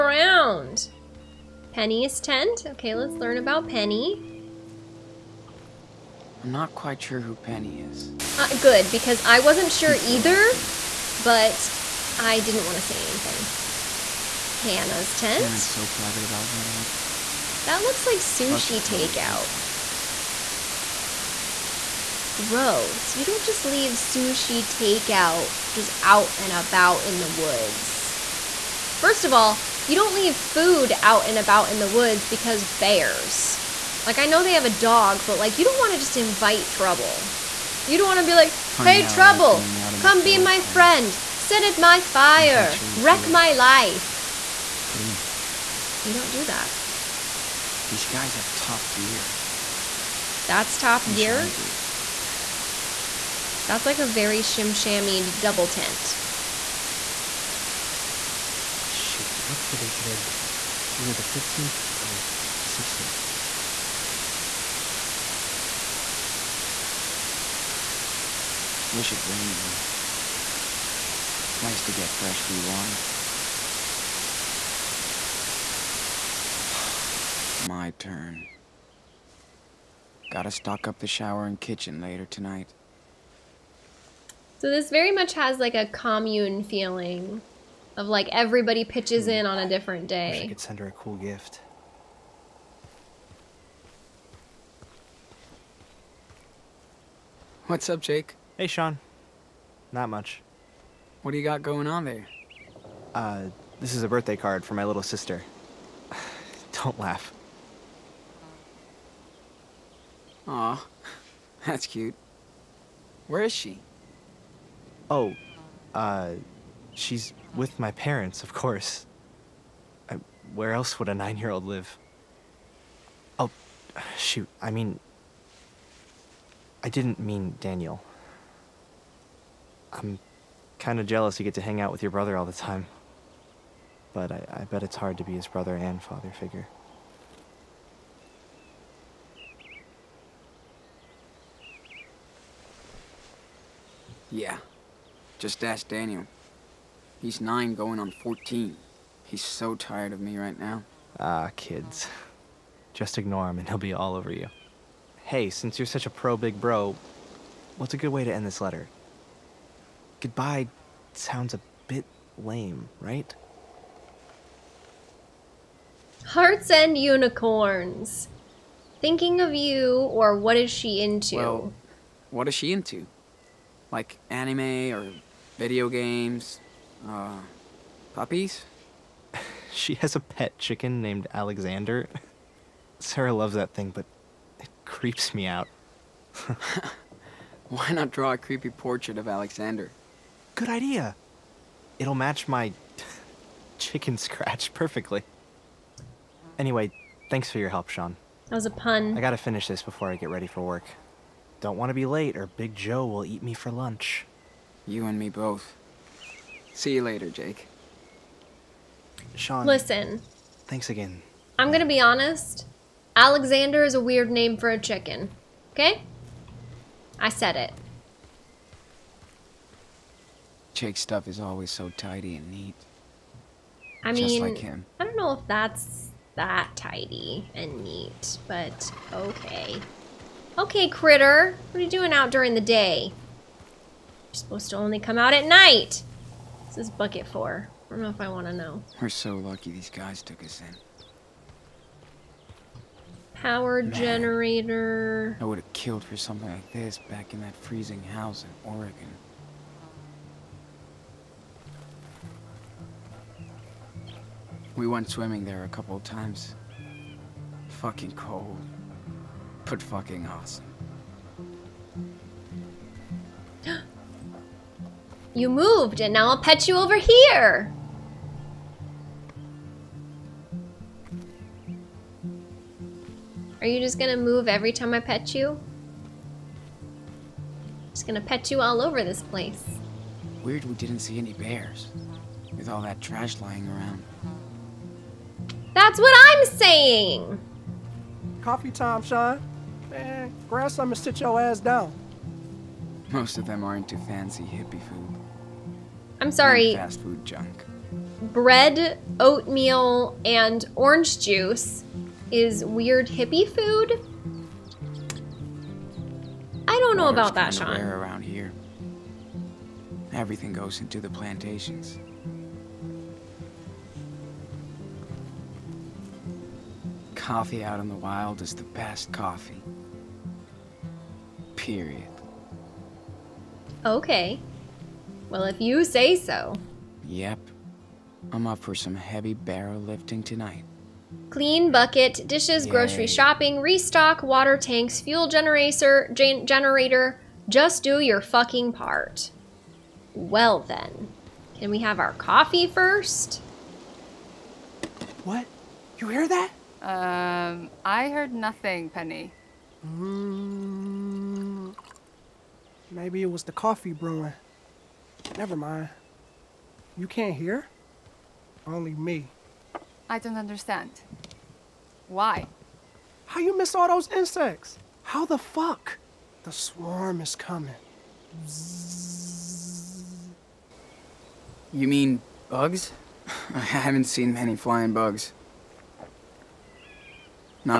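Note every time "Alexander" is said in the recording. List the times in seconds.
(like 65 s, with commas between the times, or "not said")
181 s, 189 s, 213 s.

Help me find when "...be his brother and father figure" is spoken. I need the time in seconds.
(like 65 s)
135 s.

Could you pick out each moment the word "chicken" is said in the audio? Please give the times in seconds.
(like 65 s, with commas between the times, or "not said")
180 s, 193 s, 214 s.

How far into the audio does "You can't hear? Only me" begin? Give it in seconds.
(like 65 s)
356 s.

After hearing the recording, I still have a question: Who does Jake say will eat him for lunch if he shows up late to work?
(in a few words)
Big Joe.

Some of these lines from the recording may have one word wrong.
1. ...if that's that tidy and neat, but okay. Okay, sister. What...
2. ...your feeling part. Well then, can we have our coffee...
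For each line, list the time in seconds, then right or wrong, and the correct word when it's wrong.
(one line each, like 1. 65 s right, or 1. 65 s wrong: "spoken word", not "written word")
1. 225 s wrong: "critter", not "sister"
2. 337 s wrong: "fucking", not "feeling".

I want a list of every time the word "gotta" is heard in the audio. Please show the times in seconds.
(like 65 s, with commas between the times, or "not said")
80 s, 199 s.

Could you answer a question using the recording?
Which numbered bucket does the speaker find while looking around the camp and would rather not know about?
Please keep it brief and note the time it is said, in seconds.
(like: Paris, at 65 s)
4, at 236 s.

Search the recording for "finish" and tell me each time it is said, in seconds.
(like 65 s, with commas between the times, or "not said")
199 s.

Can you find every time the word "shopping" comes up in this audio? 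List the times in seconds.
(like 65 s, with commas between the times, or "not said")
333 s.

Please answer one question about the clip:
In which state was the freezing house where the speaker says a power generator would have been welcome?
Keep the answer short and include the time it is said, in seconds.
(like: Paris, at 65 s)
Oregon, at 248 s.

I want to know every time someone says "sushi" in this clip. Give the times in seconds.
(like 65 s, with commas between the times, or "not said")
18 s, 23 s.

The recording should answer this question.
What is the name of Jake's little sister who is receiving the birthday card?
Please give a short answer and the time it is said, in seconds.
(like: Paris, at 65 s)
Sarah, at 182 s.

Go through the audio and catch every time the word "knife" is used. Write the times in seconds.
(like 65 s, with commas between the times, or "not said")
not said.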